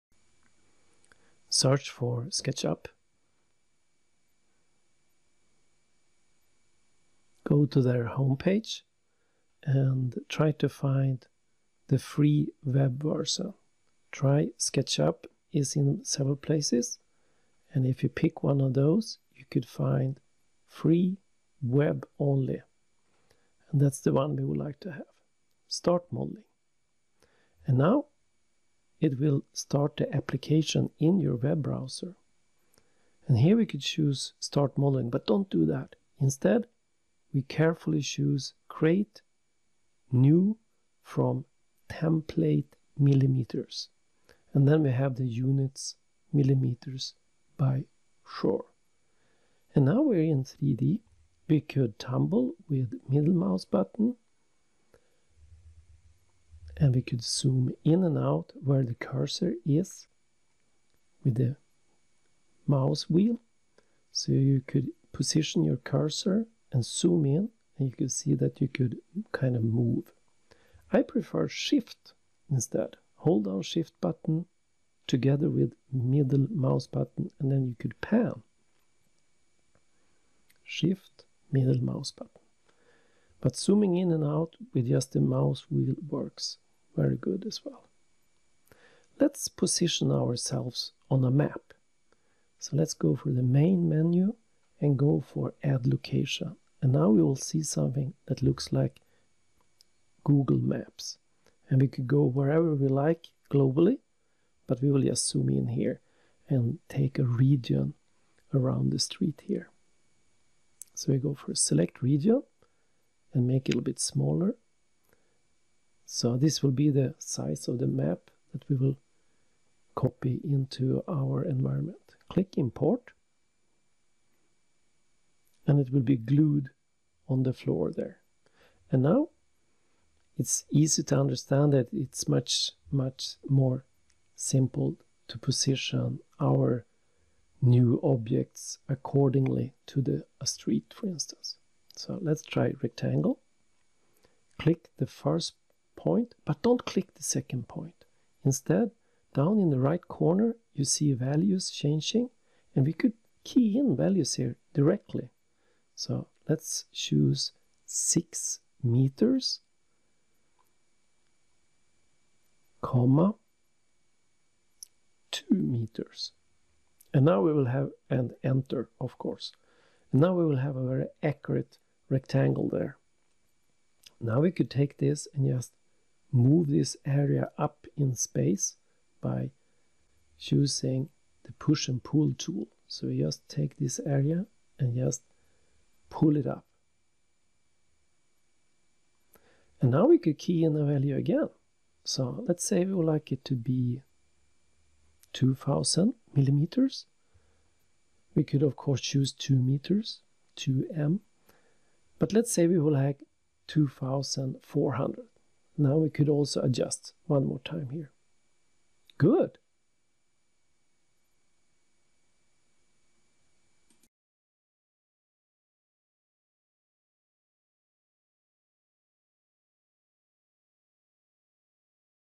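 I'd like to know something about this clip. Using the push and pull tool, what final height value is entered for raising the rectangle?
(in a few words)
2400.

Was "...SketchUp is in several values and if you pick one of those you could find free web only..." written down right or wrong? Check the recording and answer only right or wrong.
wrong.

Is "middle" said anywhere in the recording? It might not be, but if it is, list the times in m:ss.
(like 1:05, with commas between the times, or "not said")
0:53, 1:15, 1:21.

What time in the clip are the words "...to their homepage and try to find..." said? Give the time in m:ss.
0:07.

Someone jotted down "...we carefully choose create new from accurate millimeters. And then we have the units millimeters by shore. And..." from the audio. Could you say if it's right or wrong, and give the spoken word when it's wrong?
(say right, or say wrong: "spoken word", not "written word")
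wrong: "template", not "accurate".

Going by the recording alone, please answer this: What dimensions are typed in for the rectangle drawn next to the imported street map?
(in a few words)
6 meters, 2 meters.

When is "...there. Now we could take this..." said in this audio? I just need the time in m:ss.
2:52.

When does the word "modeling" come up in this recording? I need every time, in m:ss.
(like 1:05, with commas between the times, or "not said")
0:26, 0:34.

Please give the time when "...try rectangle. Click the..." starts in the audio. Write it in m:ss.
2:22.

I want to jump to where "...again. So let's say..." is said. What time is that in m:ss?
3:11.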